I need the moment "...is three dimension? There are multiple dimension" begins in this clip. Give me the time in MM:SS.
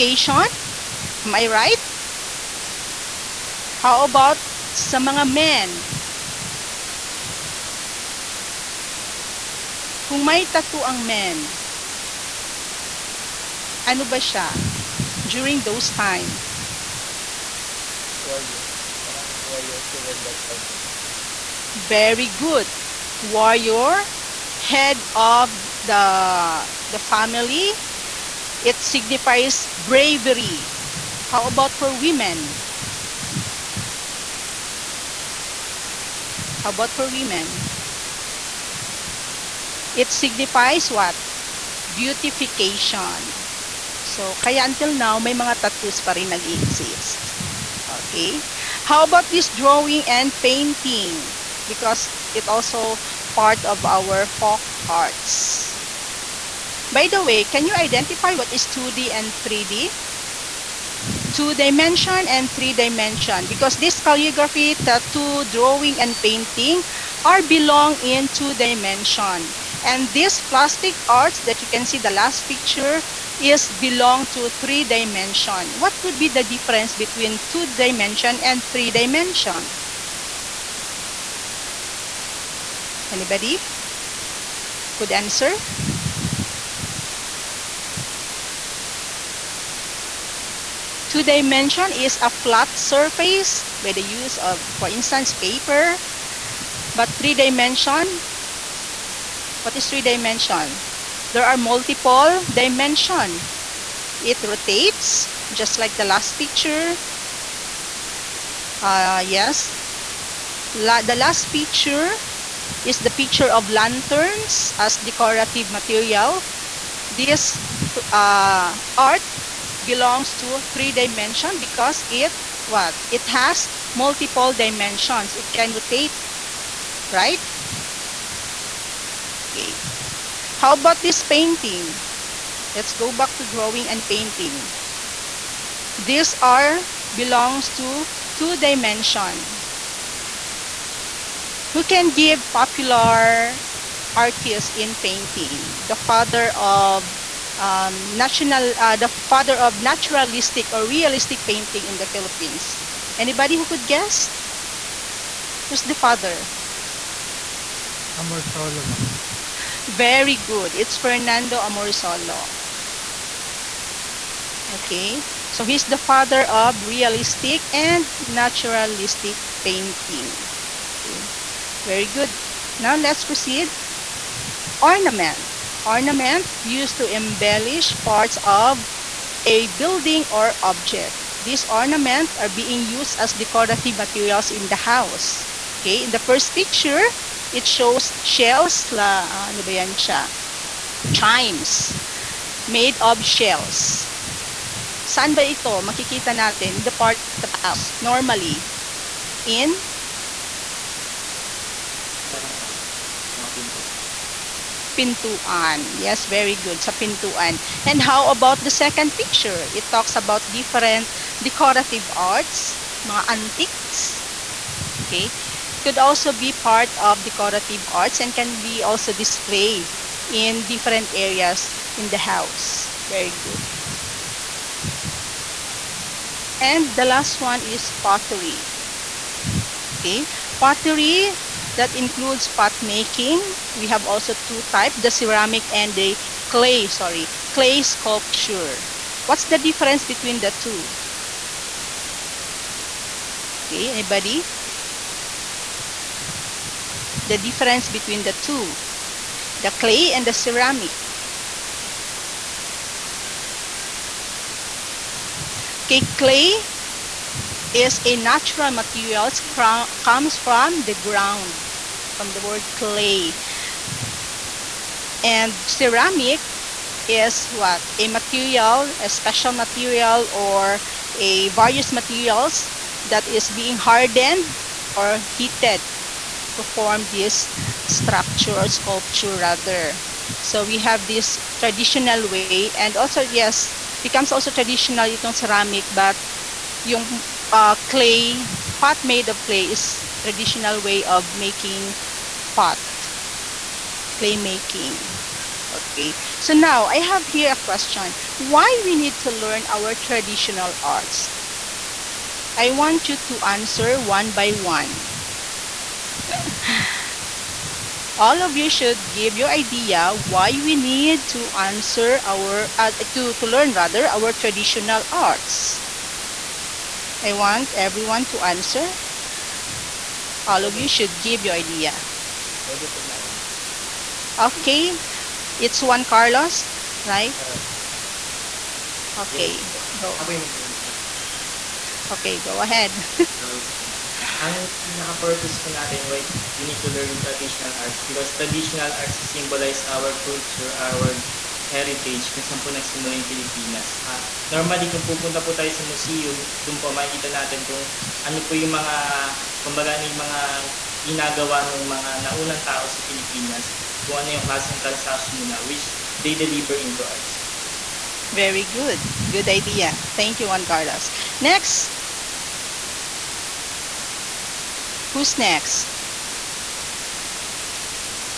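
01:39.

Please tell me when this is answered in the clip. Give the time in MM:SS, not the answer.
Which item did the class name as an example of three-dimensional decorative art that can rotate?
01:53.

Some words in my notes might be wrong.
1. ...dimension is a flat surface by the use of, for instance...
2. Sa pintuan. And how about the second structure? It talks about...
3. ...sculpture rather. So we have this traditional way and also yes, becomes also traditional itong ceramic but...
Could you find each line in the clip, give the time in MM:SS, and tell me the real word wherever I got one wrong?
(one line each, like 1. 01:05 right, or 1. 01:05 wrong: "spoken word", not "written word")
1. 01:31 right
2. 03:26 wrong: "picture", not "structure"
3. 04:38 right.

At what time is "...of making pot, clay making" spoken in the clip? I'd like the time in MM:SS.
04:51.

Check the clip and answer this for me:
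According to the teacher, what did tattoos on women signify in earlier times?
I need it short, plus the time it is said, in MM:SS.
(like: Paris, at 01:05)
Beautification, at 00:41.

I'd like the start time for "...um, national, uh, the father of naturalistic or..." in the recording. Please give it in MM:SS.
02:27.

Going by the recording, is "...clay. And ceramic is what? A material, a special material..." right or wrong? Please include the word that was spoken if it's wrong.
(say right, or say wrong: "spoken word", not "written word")
right.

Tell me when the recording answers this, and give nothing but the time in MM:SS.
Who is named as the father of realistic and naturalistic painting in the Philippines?
02:40.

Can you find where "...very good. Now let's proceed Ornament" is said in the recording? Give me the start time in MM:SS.
02:51.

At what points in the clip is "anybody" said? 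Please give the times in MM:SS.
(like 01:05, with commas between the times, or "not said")
01:23, 02:33, 04:03.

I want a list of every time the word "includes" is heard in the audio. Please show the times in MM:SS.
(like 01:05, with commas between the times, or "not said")
03:51.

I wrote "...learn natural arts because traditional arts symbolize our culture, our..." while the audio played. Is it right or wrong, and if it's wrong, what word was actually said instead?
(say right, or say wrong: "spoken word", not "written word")
wrong: "traditional", not "natural".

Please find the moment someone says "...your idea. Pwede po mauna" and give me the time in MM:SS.
05:21.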